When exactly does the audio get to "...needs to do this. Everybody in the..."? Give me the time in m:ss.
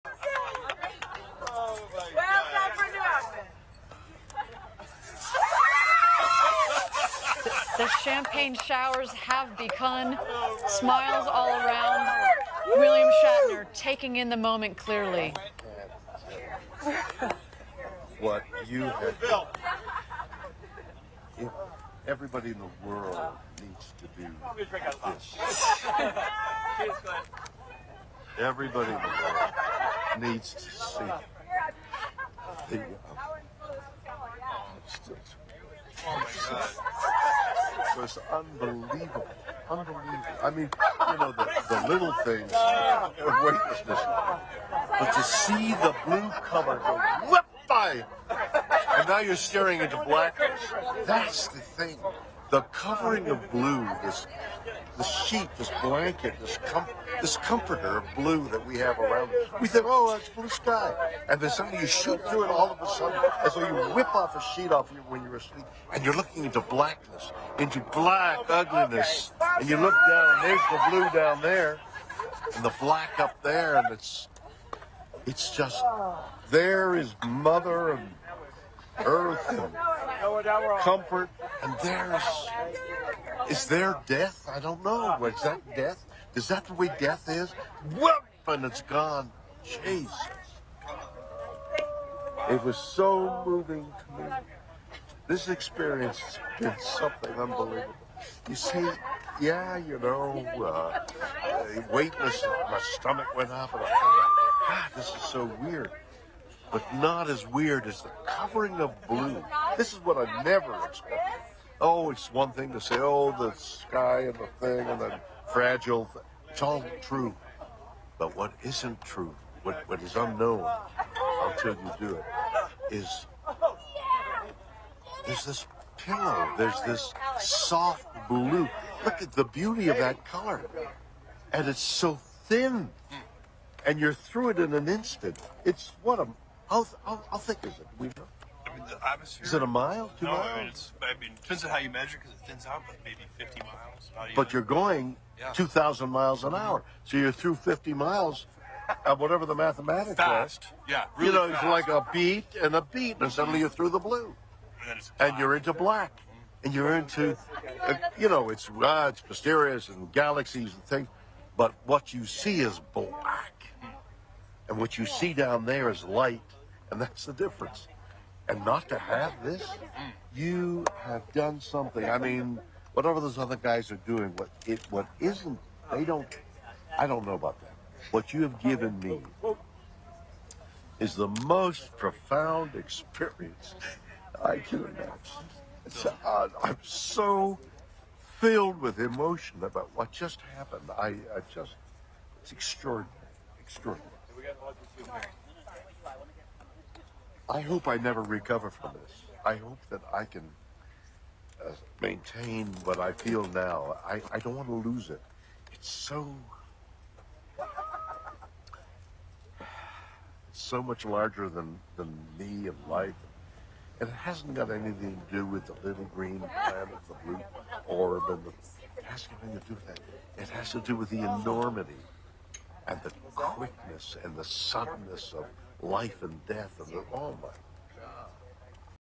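0:23.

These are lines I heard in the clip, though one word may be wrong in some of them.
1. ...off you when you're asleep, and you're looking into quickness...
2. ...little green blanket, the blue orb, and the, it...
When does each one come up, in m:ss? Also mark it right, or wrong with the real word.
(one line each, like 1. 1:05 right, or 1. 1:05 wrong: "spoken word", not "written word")
1. 1:04 wrong: "blackness", not "quickness"
2. 3:35 wrong: "planet", not "blanket".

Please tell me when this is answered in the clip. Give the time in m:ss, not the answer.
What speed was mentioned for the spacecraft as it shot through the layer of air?
2:25.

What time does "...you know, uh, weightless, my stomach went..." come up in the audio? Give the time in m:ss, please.
1:39.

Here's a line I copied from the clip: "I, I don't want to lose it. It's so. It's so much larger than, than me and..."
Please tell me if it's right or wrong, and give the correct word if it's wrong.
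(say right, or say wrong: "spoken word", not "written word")
right.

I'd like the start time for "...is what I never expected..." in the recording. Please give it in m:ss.
1:49.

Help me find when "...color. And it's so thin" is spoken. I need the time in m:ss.
2:10.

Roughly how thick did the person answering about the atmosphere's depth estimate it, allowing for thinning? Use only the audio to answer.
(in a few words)
50 miles.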